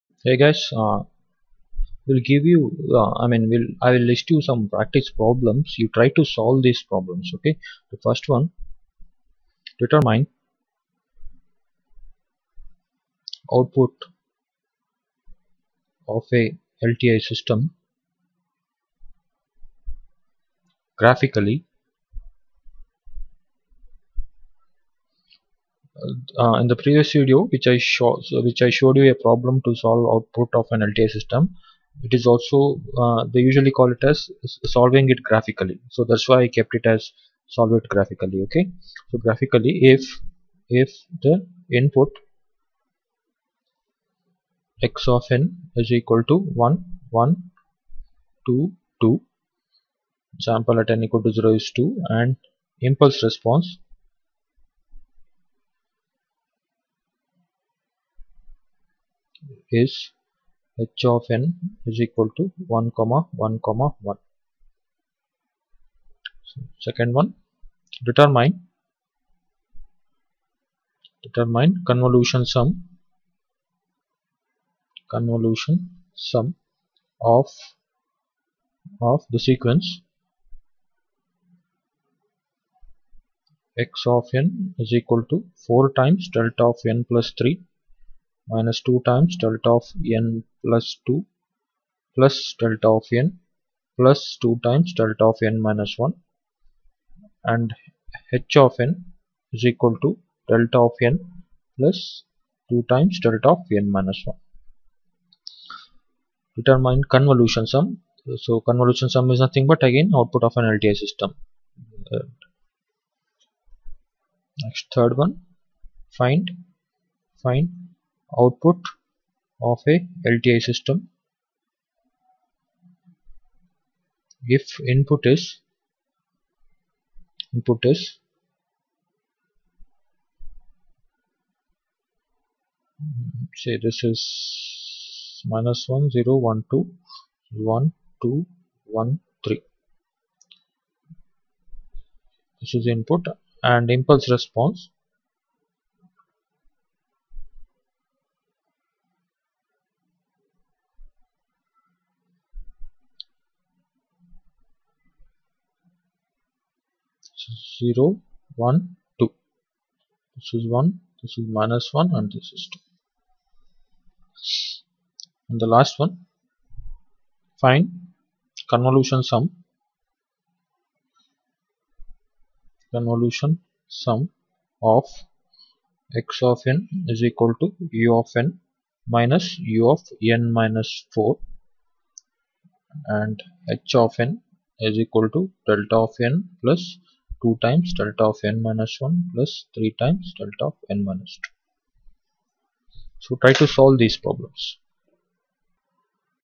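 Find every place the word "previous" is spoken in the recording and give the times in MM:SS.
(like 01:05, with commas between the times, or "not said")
00:26.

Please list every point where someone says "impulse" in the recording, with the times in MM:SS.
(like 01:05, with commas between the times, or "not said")
00:52, 02:23.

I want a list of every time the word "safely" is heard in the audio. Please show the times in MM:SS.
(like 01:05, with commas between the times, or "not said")
not said.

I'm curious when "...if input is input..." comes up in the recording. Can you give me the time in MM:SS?
02:04.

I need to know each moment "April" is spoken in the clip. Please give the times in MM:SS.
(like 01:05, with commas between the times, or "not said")
not said.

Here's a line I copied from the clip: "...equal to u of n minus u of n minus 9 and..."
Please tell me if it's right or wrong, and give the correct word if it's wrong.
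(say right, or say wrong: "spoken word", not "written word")
wrong: "4", not "9".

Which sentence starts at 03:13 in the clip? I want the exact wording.
So try to solve these problems.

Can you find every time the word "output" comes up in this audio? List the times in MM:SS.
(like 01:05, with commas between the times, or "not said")
00:13, 00:30, 01:50, 01:58.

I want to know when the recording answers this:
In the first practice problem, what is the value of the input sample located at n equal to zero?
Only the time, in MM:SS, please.
00:50.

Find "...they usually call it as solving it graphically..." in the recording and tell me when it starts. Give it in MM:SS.
00:33.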